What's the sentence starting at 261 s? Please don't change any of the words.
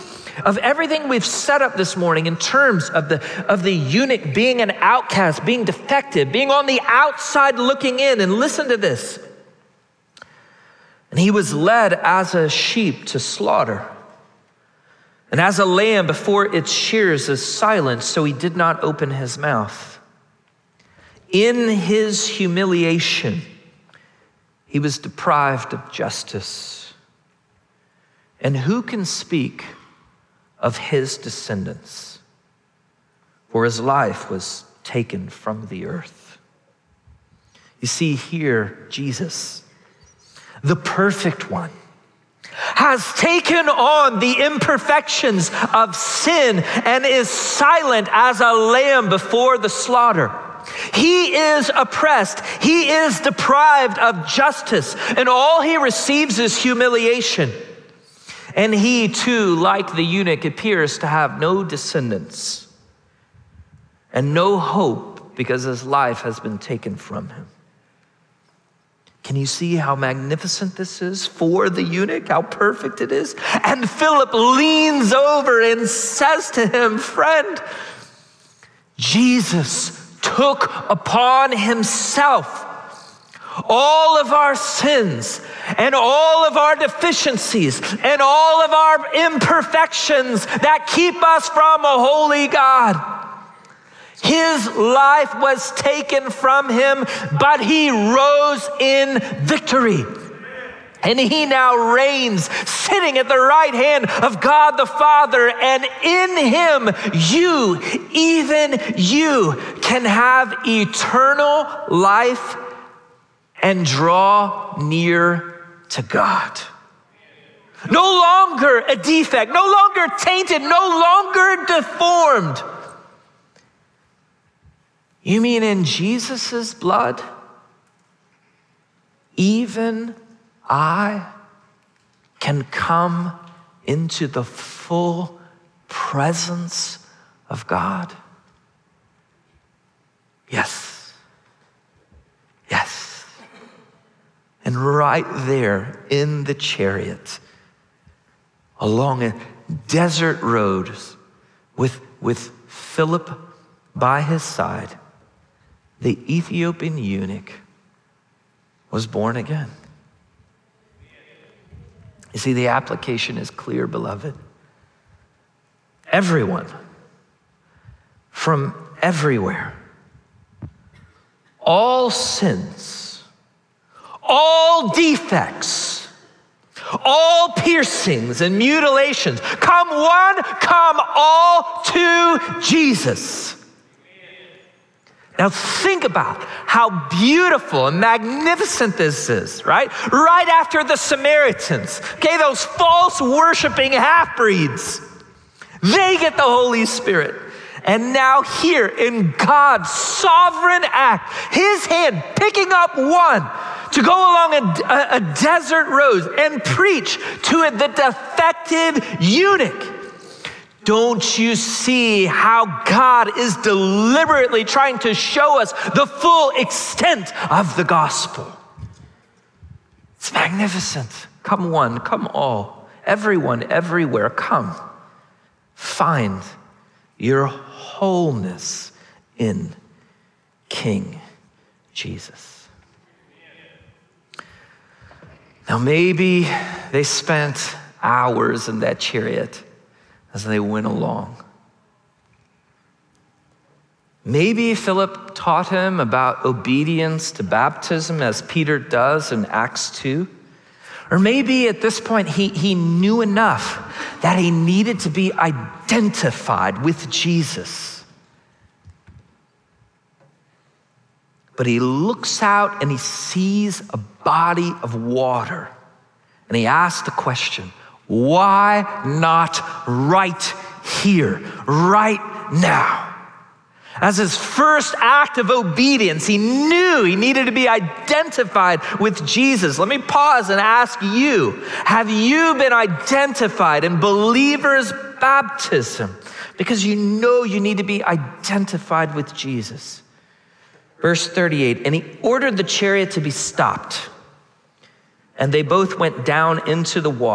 But he looks out and he sees a body of water and he asks the question why not right here, right now?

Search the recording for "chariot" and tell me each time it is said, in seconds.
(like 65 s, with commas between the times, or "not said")
146 s, 239 s, 292 s.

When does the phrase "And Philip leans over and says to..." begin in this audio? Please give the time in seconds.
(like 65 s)
73 s.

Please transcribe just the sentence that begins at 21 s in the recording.
In his humiliation, he was deprived of justice.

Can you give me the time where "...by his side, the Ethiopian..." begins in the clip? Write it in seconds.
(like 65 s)
153 s.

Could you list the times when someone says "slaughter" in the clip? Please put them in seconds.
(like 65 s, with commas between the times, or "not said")
13 s, 49 s.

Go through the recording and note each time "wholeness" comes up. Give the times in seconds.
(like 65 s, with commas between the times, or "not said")
227 s.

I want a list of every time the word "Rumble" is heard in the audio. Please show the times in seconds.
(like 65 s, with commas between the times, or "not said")
not said.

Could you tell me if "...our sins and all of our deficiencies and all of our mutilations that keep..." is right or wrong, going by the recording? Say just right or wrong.
wrong.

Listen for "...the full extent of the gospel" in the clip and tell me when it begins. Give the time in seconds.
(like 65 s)
215 s.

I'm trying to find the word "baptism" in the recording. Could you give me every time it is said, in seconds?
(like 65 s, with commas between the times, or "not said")
247 s, 285 s.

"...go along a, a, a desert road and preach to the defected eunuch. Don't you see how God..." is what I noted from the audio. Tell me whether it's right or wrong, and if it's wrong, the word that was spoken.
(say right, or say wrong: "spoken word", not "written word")
right.